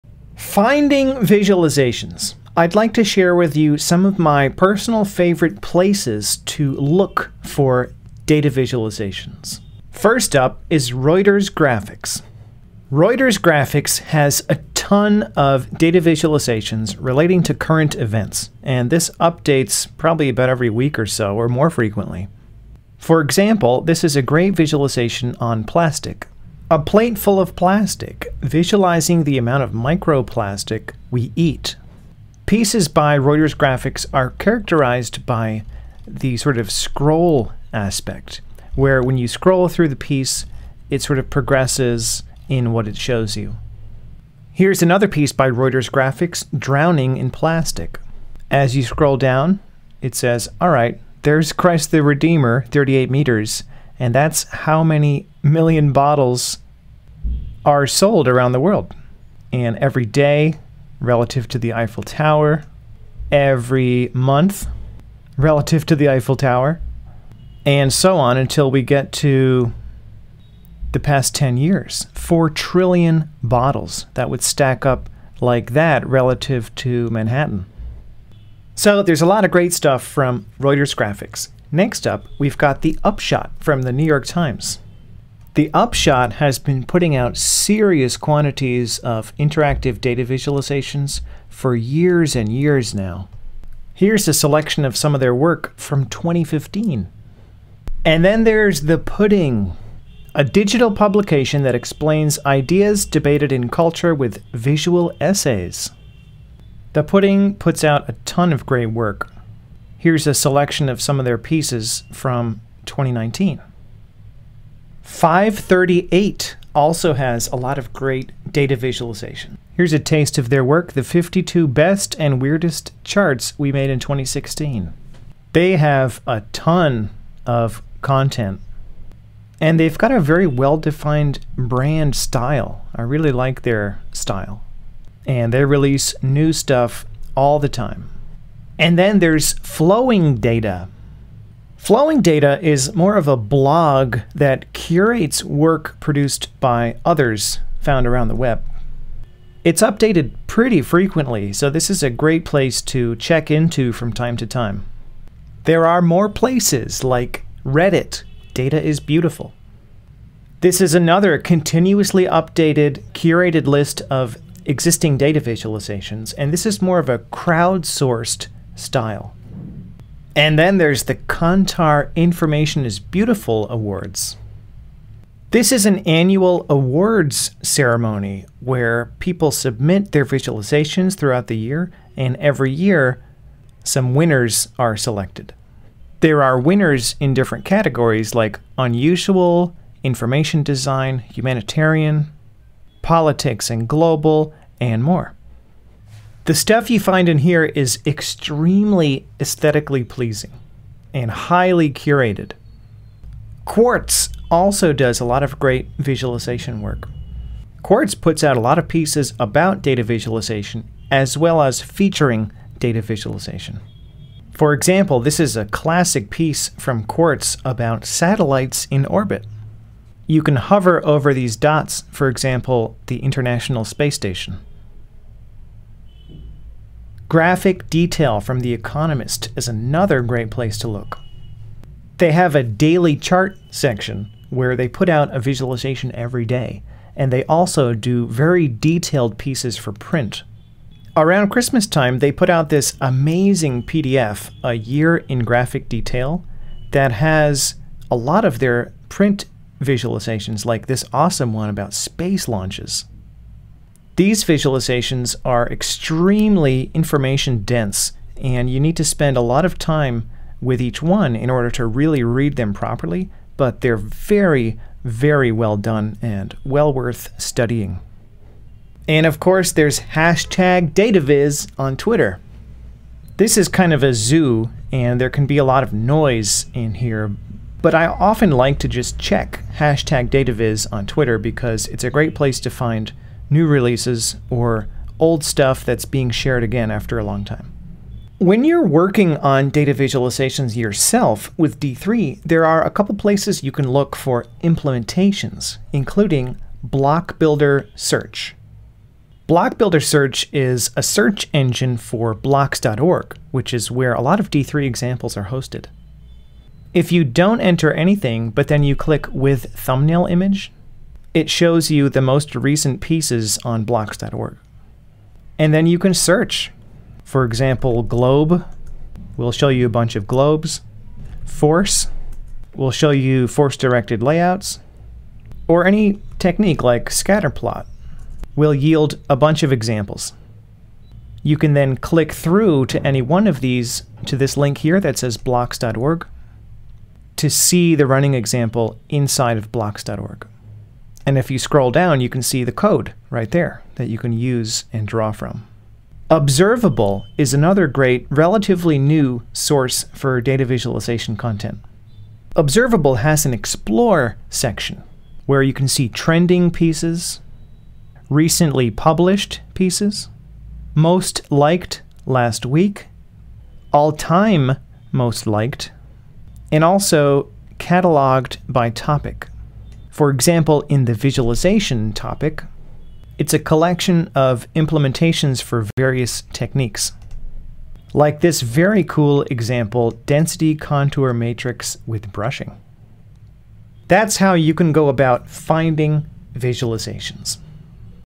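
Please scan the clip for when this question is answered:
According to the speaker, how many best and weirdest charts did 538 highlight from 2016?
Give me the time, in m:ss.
2:01.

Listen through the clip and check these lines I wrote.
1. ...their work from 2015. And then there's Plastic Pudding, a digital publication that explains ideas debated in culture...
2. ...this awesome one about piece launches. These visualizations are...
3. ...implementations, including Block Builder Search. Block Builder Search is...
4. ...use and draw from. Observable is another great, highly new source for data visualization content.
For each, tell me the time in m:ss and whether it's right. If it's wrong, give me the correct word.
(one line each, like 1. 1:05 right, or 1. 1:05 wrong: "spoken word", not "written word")
1. 1:35 wrong: "The", not "Plastic"
2. 4:10 wrong: "space", not "piece"
3. 4:54 right
4. 5:44 wrong: "relatively", not "highly".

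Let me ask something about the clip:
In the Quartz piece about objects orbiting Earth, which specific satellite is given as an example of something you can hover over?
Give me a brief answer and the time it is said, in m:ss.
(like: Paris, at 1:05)
International Space Station, at 3:43.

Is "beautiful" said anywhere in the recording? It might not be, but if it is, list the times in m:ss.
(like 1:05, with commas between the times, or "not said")
2:38, 2:52.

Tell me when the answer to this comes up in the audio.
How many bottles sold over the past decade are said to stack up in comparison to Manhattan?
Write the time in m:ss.
1:12.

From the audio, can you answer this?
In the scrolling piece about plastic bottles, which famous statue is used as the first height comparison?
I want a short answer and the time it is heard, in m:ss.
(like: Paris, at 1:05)
Christ the Redeemer, at 0:51.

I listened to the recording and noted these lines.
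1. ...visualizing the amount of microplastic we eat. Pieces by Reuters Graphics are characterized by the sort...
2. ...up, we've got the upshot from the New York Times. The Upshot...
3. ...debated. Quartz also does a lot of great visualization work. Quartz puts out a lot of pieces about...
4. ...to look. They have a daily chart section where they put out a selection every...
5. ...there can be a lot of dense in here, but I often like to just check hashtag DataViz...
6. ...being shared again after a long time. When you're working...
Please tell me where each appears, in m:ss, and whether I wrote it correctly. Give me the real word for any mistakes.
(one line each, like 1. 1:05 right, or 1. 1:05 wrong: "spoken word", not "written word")
1. 0:28 right
2. 1:22 right
3. 3:21 wrong: "curated", not "debated"
4. 3:50 wrong: "visualization", not "selection"
5. 4:35 wrong: "noise", not "dense"
6. 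4:46 right.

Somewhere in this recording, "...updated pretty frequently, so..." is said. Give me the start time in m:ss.
2:29.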